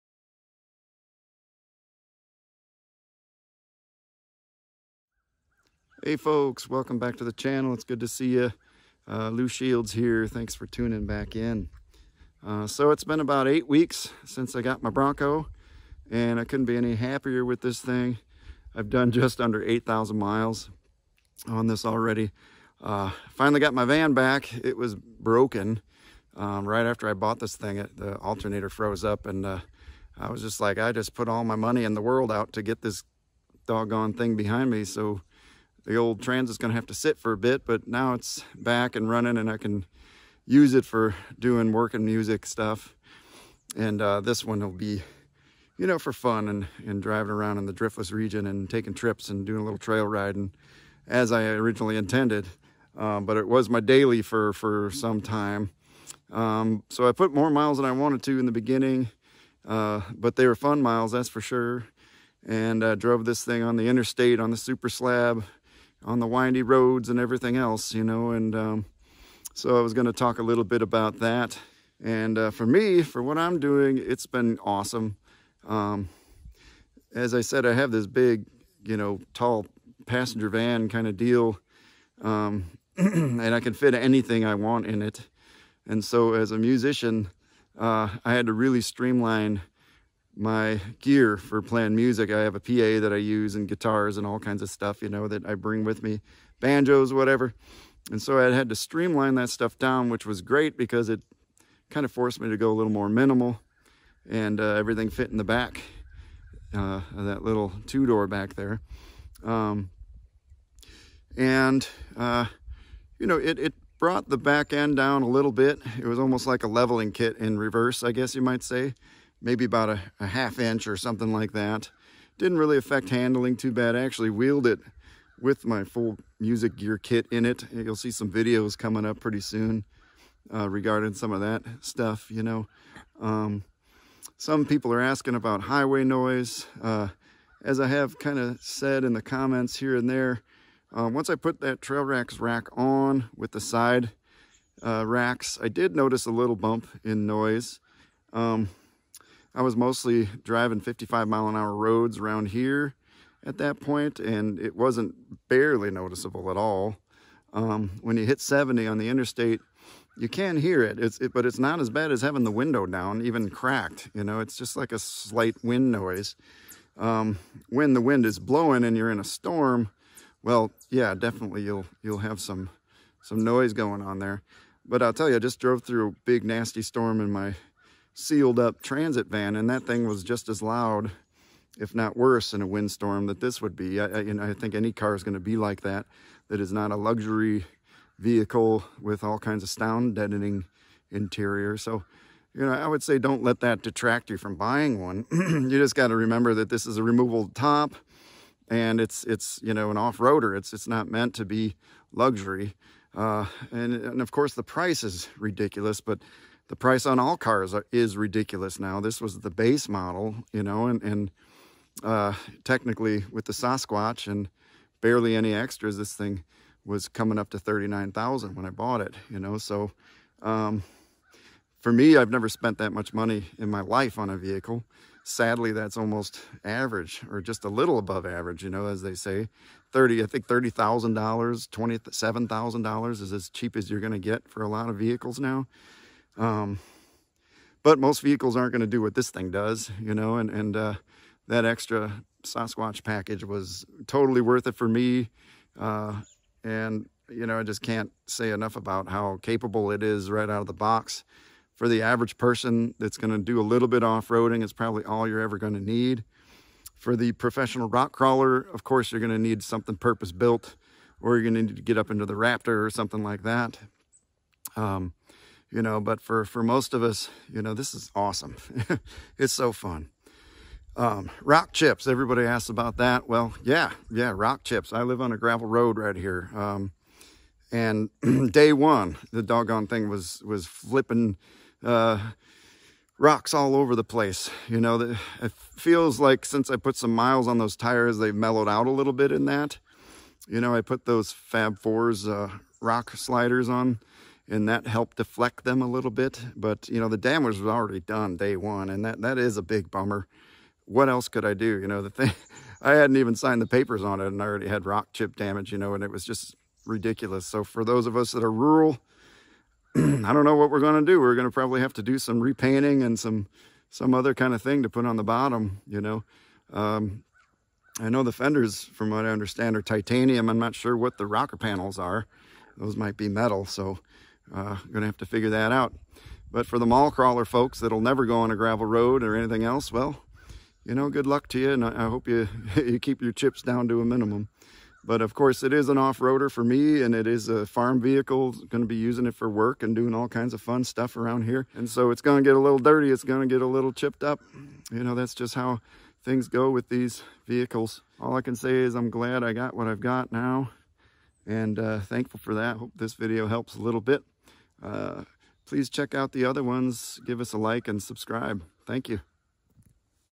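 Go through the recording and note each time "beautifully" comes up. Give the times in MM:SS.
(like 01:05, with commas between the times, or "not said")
not said.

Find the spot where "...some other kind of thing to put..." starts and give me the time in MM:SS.
05:13.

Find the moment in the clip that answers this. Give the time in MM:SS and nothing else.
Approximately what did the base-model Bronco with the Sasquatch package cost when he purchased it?
03:37.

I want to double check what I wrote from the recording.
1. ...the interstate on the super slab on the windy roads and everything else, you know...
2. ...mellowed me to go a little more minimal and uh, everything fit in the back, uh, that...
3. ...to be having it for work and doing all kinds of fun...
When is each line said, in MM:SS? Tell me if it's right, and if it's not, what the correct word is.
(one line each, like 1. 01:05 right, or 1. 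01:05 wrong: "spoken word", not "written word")
1. 01:03 right
2. 01:42 wrong: "forced", not "mellowed"
3. 05:38 wrong: "using", not "having".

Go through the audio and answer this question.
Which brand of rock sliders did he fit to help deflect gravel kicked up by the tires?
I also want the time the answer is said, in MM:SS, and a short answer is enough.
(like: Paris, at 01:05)
Fab Fours, at 04:51.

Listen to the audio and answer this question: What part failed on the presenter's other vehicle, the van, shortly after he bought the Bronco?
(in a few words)
alternator.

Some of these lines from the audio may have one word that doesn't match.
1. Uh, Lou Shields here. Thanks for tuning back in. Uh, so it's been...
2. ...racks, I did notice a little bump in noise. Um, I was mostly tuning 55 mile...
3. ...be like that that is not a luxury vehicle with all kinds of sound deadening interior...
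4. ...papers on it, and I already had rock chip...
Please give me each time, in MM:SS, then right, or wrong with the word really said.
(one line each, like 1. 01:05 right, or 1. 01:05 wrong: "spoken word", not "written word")
1. 00:09 right
2. 02:25 wrong: "driving", not "tuning"
3. 03:05 right
4. 05:03 right.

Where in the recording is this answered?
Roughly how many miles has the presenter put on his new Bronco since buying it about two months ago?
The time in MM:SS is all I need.
00:19.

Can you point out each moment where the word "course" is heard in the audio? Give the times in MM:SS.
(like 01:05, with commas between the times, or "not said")
03:24, 04:18, 05:35.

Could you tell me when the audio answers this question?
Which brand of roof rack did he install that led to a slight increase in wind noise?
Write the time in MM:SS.
02:21.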